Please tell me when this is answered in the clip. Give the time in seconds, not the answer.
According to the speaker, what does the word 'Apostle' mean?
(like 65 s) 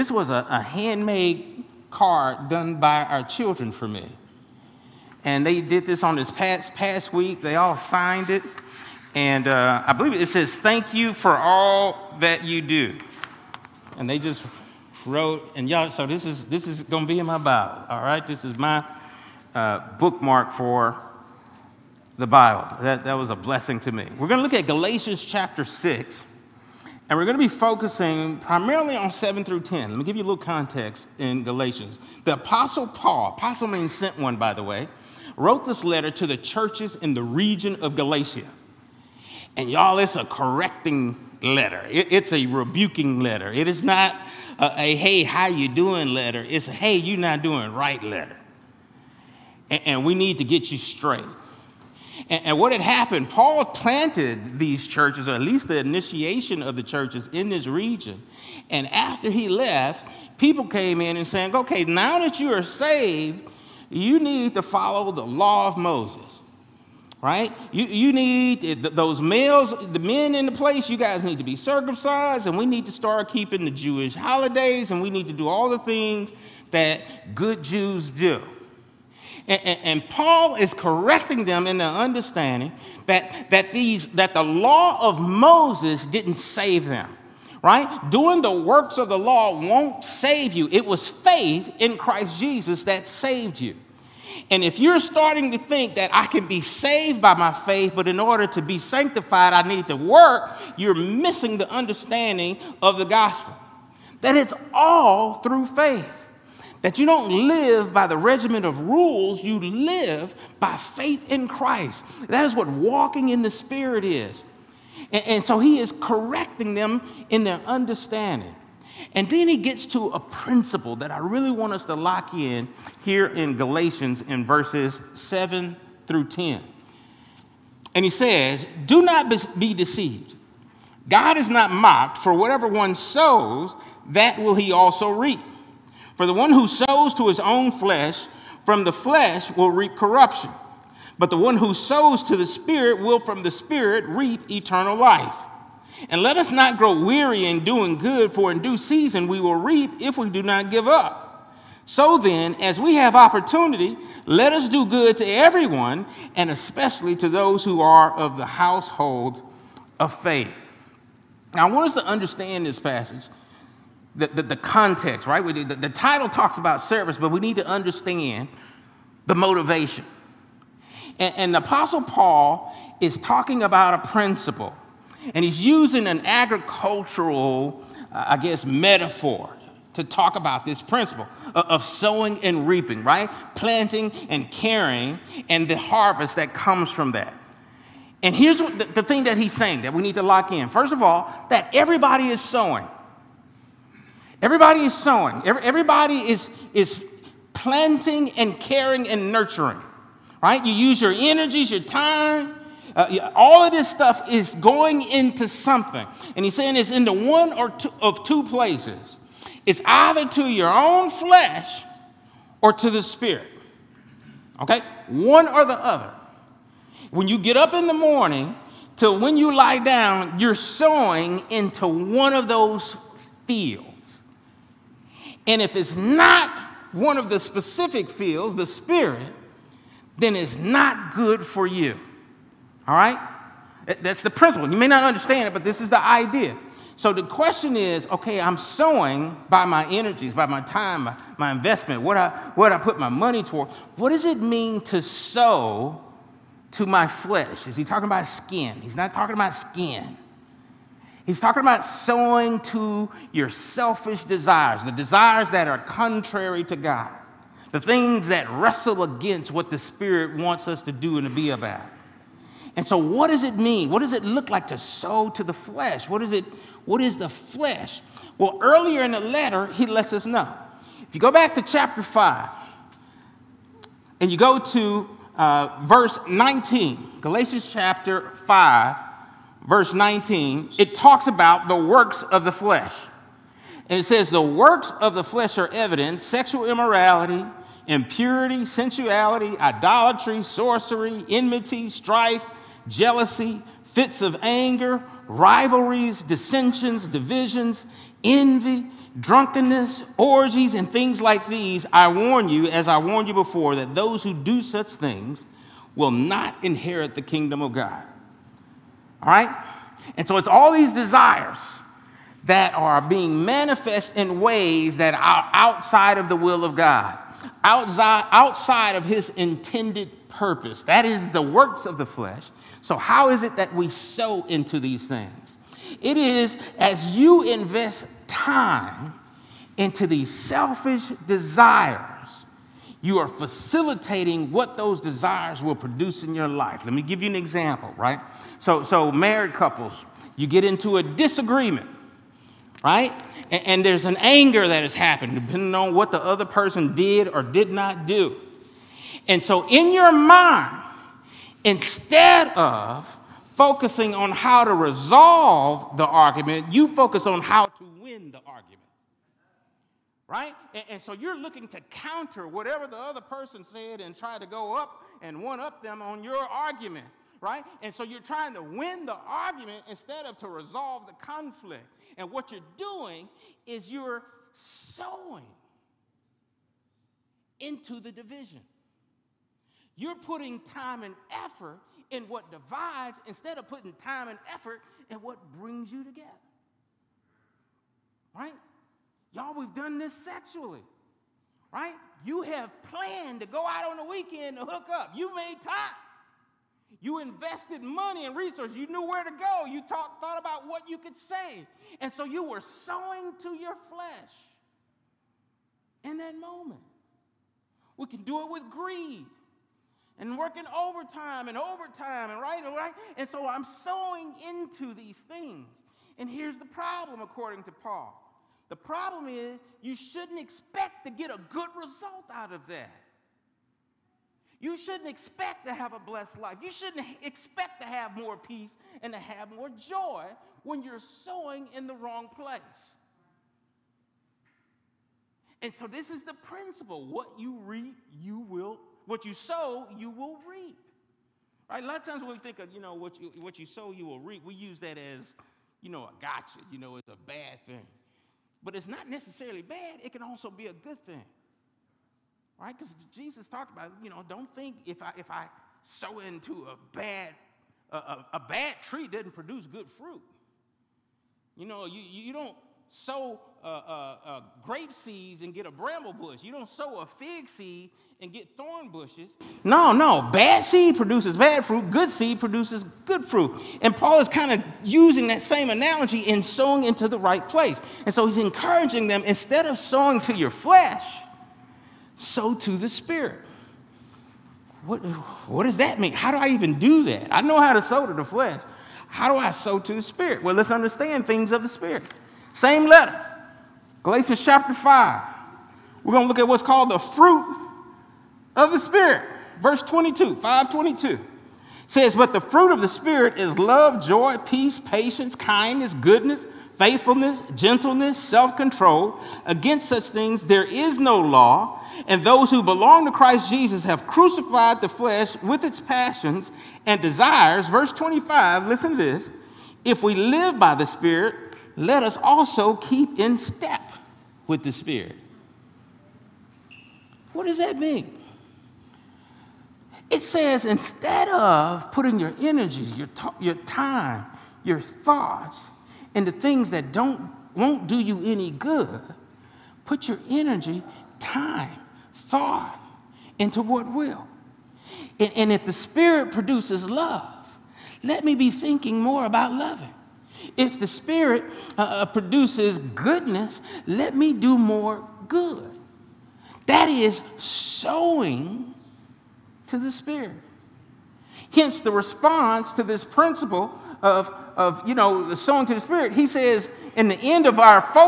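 33 s.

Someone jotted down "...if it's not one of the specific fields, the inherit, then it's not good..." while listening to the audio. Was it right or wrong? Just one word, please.
wrong.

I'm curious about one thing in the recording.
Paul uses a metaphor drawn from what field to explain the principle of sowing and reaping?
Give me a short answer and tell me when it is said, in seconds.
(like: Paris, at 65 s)
agricultural, at 176 s.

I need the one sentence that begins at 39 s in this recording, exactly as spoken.
And y'all, it's a correcting letter, it, it's a rebuking letter.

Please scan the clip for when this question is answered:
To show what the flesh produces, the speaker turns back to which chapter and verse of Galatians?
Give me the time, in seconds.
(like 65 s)
277 s.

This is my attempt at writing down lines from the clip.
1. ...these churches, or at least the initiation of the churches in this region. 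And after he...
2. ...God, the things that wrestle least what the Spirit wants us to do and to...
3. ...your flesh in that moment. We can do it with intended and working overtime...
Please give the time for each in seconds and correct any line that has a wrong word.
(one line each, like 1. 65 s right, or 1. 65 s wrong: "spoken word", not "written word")
1. 54 s right
2. 256 s wrong: "against", not "least"
3. 403 s wrong: "greed", not "intended".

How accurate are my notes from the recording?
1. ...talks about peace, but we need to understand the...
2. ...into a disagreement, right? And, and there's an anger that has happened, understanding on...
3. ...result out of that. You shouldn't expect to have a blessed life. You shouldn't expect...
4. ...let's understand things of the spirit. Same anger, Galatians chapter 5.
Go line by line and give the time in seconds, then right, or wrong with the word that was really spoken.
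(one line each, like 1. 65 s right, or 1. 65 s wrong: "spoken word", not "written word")
1. 166 s wrong: "service", not "peace"
2. 340 s wrong: "depending", not "understanding"
3. 421 s right
4. 490 s wrong: "letter", not "anger".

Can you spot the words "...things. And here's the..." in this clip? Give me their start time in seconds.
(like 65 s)
415 s.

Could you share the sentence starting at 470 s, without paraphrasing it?
Bad seed produces bad fruit, good seed produces good fruit.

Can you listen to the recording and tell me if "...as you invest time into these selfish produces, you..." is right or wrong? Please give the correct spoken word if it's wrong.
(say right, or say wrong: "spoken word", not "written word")
wrong: "desires", not "produces".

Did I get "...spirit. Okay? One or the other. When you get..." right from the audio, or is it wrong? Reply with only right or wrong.
right.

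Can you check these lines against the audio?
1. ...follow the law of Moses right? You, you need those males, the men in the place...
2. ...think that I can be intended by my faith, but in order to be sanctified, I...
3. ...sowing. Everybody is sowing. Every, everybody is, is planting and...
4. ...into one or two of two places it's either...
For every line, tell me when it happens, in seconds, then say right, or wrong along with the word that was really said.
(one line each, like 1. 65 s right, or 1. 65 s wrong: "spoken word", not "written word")
1. 64 s right
2. 95 s wrong: "saved", not "intended"
3. 192 s right
4. 206 s right.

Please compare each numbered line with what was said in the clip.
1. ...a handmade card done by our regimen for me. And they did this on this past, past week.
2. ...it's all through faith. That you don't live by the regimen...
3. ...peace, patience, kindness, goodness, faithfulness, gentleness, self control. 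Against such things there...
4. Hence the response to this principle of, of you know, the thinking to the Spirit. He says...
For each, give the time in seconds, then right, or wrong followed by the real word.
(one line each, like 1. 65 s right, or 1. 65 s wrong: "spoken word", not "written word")
1. 0 s wrong: "children", not "regimen"
2. 104 s right
3. 504 s right
4. 561 s wrong: "sowing", not "thinking".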